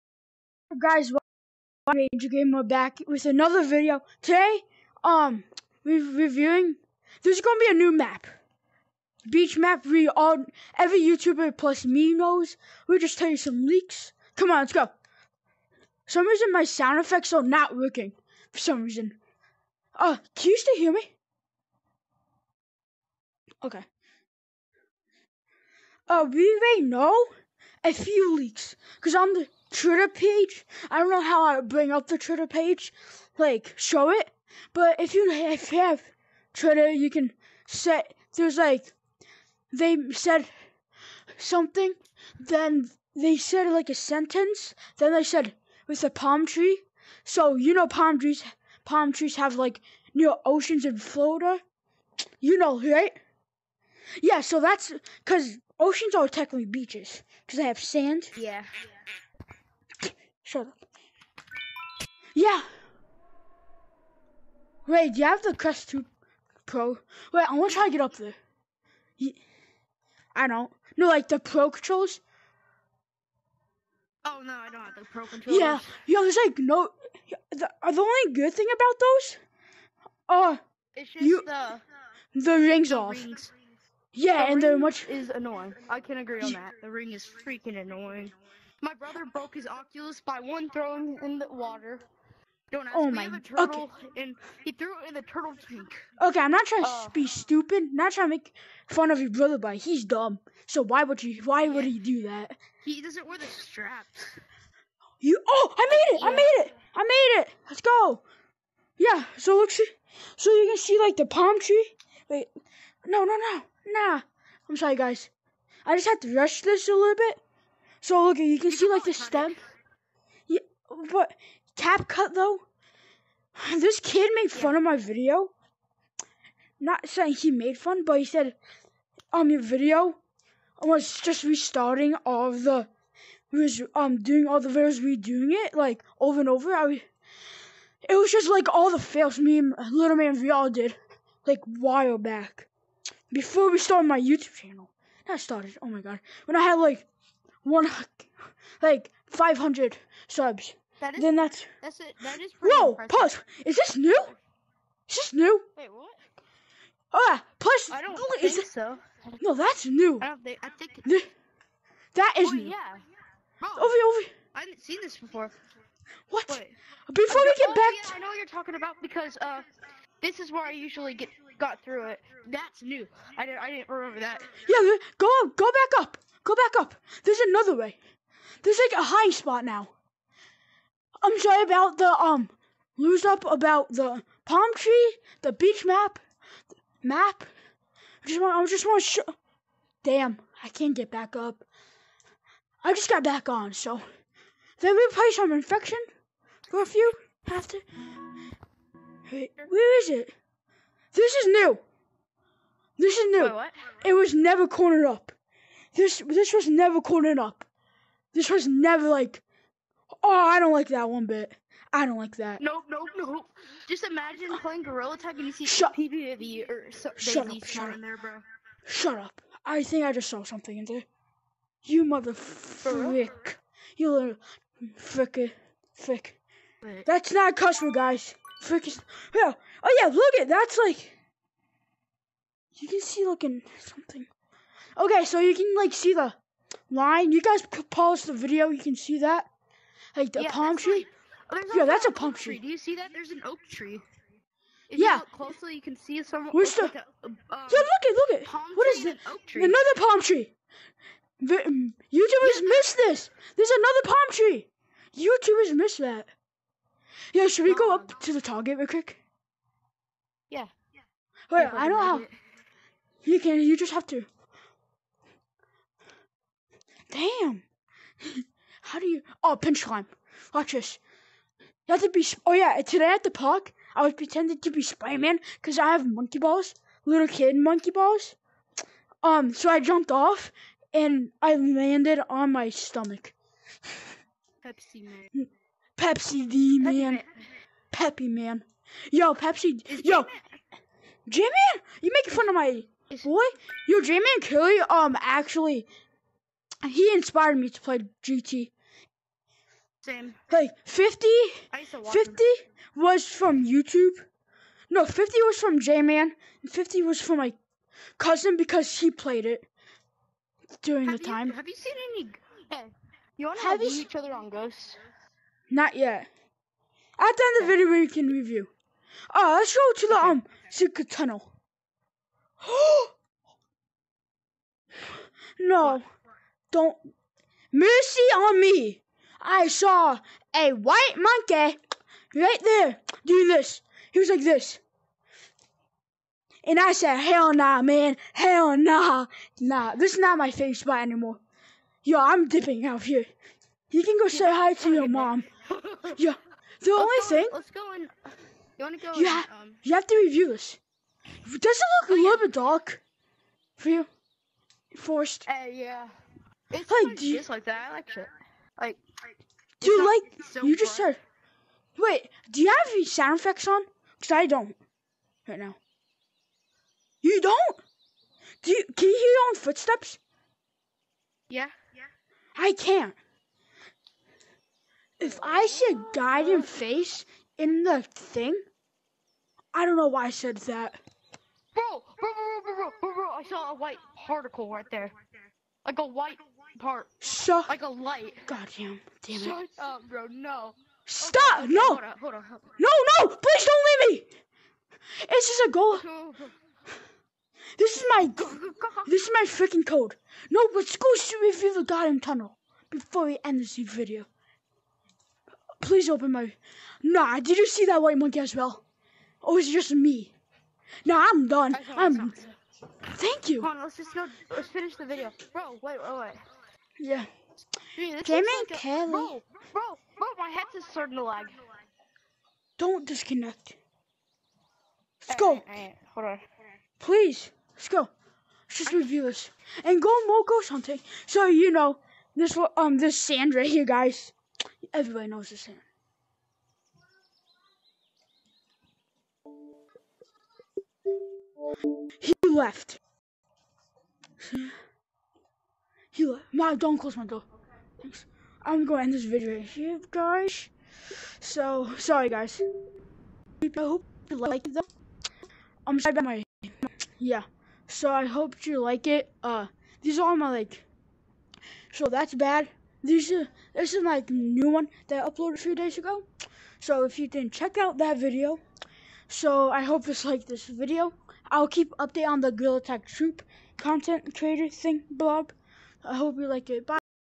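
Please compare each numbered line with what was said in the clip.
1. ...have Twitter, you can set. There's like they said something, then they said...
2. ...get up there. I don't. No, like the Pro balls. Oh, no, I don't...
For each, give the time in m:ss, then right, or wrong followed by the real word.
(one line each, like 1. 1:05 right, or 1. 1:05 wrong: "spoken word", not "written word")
1. 0:35 right
2. 1:07 wrong: "controls", not "balls".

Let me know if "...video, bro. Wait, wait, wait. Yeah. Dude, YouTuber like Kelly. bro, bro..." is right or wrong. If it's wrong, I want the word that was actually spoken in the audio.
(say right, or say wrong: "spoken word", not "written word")
wrong: "Jamie", not "YouTuber".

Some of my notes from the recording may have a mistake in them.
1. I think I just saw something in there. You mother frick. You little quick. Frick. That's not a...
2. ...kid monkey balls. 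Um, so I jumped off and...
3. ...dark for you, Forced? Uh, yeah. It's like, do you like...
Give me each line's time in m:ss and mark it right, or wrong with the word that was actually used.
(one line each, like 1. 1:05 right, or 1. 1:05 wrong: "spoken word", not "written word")
1. 3:39 wrong: "frick", not "quick"
2. 4:37 right
3. 5:52 right.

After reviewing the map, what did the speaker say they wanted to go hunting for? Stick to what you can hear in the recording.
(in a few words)
Moco.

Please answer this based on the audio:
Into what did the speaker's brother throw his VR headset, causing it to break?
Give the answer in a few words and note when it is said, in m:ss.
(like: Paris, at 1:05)
The turtle tank, at 1:35.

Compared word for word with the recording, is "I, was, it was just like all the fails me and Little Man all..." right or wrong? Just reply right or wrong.
right.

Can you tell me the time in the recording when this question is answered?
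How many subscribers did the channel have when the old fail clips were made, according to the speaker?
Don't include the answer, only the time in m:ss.
2:29.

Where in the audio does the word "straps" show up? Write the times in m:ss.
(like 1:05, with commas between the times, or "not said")
1:43.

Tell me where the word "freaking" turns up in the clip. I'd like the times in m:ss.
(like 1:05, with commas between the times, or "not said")
1:27, 6:39.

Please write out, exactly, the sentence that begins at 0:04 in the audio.
Today, um, we're reviewing, there's gonna be a new map.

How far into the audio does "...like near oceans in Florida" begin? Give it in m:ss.
0:49.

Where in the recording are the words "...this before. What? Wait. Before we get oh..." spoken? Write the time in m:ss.
2:45.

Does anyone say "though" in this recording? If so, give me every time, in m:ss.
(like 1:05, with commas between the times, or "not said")
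2:02, 7:34.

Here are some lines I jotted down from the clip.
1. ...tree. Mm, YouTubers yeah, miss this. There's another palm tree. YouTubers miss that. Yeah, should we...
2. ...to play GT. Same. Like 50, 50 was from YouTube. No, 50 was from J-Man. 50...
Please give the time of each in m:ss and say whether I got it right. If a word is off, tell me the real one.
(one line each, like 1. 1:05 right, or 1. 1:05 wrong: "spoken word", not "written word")
1. 4:10 right
2. 4:57 right.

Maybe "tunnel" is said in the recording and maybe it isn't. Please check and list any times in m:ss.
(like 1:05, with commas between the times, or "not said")
5:21, 6:42.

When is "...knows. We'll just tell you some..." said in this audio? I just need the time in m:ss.
0:12.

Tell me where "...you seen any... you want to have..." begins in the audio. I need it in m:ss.
5:11.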